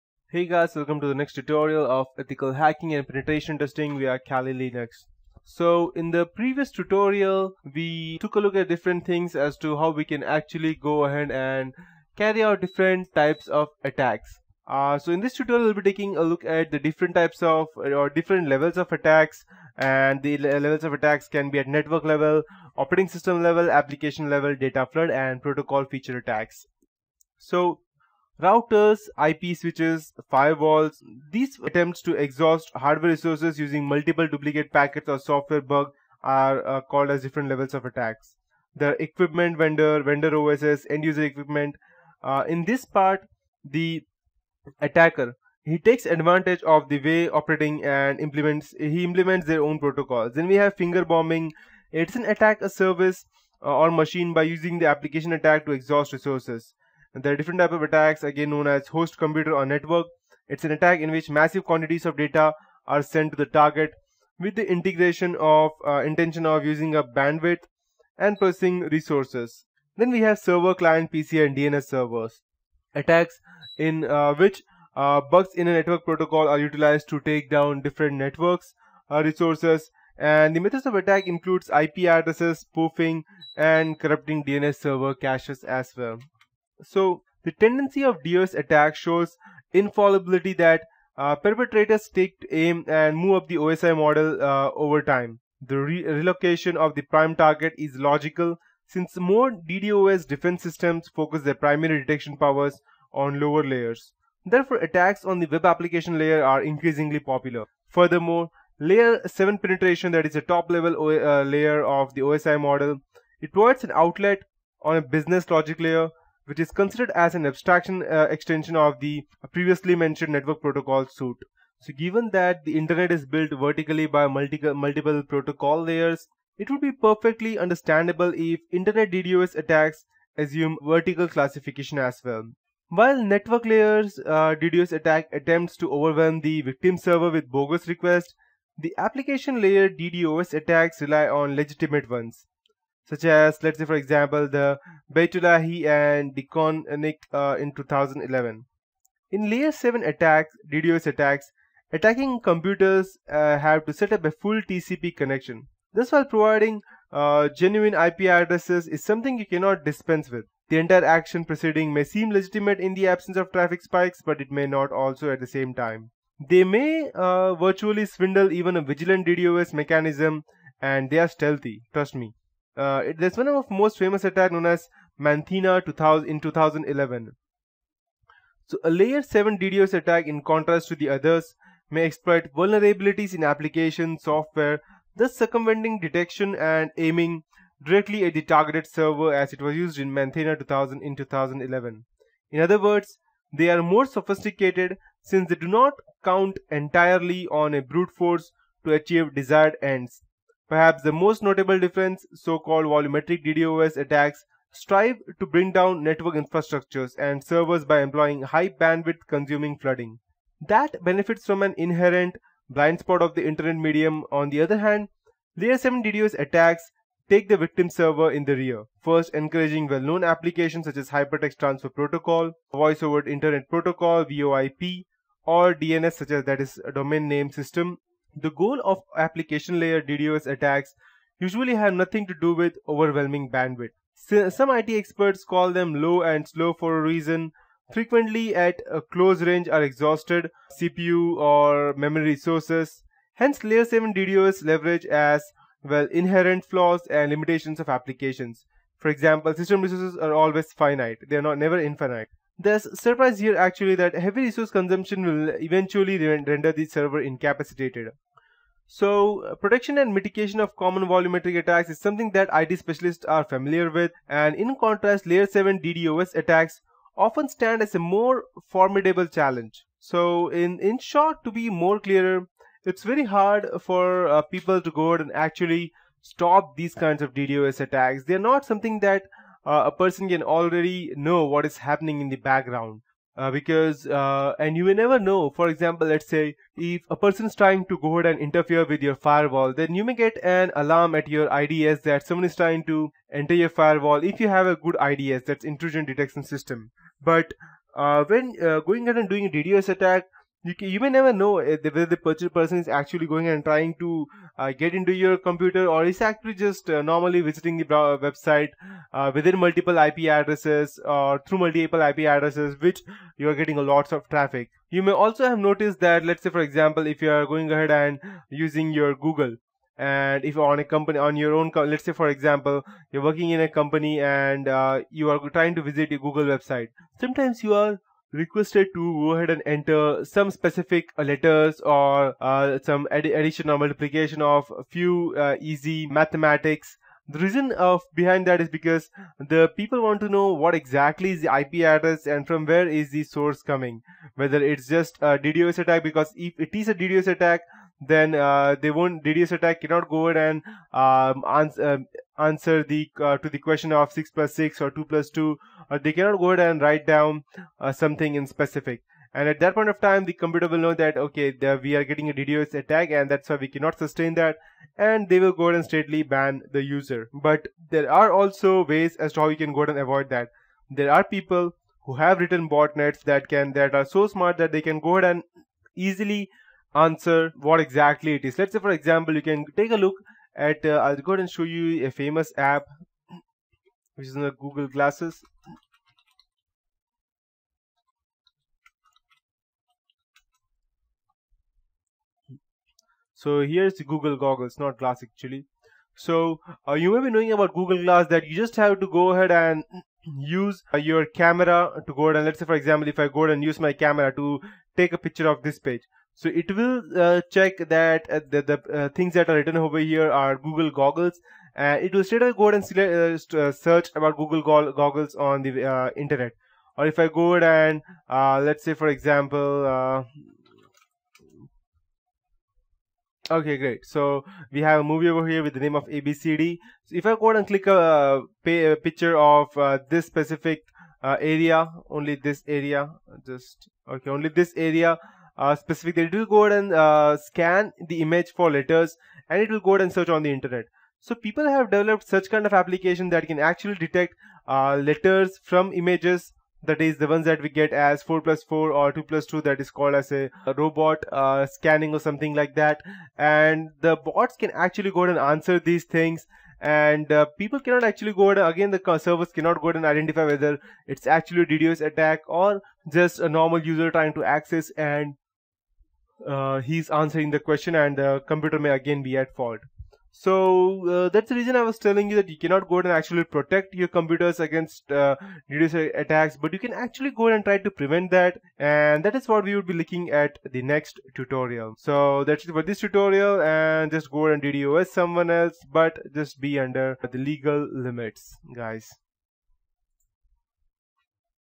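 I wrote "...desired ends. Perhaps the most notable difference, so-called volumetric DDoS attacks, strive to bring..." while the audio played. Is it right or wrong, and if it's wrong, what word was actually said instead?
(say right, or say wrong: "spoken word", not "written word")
right.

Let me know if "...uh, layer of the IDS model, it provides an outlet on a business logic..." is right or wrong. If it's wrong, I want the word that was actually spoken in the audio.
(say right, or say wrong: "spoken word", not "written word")
wrong: "OSI", not "IDS".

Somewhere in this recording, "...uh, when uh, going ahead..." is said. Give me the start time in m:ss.
4:57.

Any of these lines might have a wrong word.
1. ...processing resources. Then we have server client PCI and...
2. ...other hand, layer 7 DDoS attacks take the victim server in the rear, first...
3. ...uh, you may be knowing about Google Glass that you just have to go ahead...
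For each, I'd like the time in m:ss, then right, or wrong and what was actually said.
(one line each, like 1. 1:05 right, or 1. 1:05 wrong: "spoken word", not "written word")
1. 1:08 right
2. 3:34 right
3. 6:36 right.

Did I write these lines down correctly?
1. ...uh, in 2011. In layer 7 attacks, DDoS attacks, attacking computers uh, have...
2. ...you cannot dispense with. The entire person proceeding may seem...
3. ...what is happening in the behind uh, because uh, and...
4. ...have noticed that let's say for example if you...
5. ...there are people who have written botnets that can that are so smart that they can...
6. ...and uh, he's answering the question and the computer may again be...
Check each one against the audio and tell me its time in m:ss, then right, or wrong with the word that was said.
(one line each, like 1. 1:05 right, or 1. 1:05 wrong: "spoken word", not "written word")
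1. 2:27 right
2. 2:39 wrong: "action", not "person"
3. 4:41 wrong: "background", not "behind"
4. 5:15 right
5. 6:11 right
6. 7:44 right.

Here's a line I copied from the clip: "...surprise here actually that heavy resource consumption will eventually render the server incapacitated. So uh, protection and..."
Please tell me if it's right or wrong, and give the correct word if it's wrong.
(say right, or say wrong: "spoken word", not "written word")
right.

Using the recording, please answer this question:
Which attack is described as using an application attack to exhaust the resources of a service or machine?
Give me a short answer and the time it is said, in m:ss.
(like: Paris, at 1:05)
Finger bombing, at 0:50.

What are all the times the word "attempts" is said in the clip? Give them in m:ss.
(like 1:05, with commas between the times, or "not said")
0:31, 2:15.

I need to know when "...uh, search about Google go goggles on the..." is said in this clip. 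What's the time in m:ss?
6:53.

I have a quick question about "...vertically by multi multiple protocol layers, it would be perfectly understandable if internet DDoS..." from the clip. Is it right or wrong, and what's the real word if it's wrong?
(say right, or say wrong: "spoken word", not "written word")
right.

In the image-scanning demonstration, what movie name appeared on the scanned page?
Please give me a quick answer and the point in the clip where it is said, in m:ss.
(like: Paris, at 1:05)
abcd, at 7:06.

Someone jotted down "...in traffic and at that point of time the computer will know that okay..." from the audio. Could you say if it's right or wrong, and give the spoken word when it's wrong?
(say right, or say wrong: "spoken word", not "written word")
wrong: "specific", not "traffic".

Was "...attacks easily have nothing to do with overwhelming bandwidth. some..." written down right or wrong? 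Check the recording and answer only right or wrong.
wrong.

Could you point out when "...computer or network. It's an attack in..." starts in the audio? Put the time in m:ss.
0:59.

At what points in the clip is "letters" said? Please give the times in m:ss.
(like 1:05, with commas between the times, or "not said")
5:31, 7:18, 7:24.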